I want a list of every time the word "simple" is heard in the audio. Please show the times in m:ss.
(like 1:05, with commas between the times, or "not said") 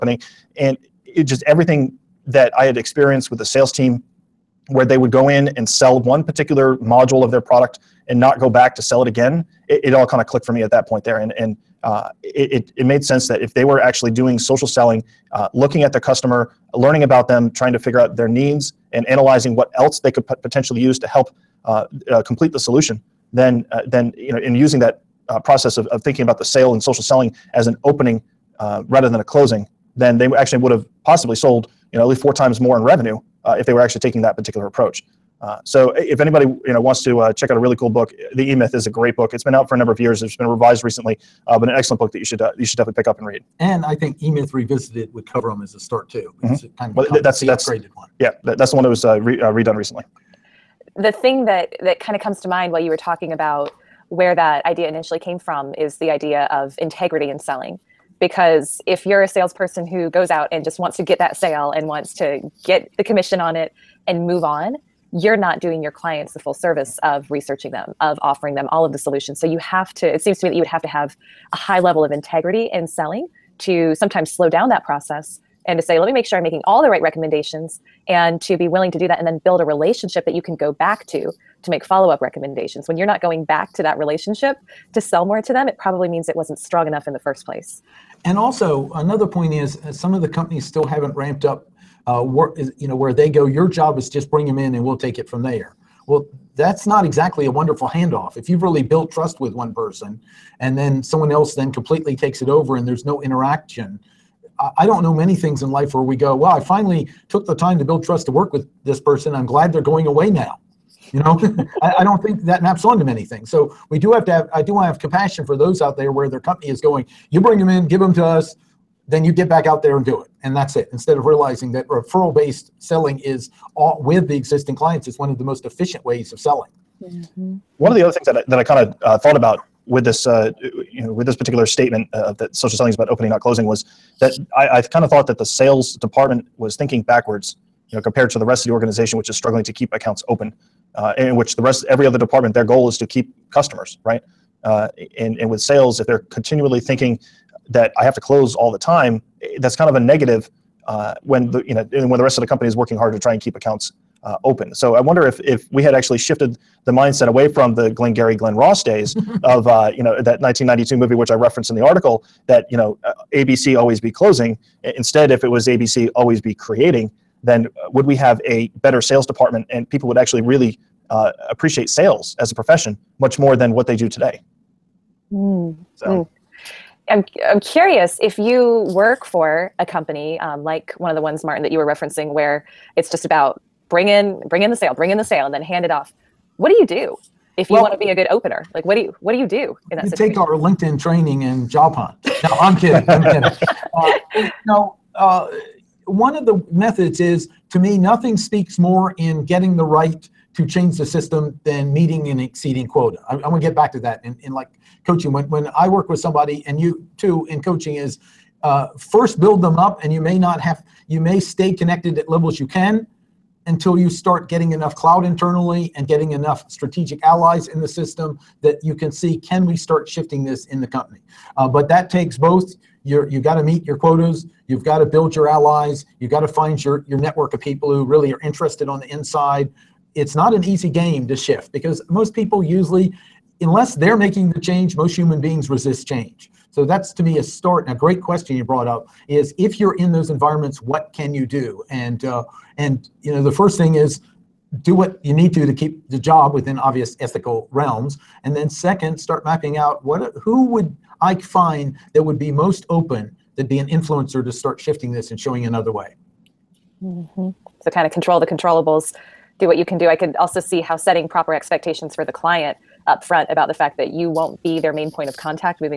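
not said.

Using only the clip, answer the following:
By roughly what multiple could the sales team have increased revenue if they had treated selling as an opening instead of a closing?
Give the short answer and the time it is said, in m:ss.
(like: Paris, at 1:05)
4 times, at 0:32.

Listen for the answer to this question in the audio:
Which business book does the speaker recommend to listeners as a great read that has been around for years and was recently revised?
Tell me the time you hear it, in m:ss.
0:38.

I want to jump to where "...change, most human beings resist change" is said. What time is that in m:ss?
3:54.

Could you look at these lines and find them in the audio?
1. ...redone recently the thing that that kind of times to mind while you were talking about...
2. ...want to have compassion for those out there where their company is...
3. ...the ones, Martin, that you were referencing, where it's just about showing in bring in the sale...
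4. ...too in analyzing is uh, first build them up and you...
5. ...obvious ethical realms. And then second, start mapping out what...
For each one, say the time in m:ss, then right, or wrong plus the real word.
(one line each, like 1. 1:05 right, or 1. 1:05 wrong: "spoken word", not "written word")
1. 0:49 wrong: "comes", not "times"
2. 1:54 right
3. 3:01 wrong: "bring", not "showing"
4. 3:27 wrong: "coaching", not "analyzing"
5. 4:06 right.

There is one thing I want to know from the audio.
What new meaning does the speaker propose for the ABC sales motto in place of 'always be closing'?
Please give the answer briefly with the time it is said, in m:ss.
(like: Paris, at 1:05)
Always be creating, at 2:46.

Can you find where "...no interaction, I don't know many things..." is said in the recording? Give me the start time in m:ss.
1:43.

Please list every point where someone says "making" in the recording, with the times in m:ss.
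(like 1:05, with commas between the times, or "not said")
1:16, 3:54.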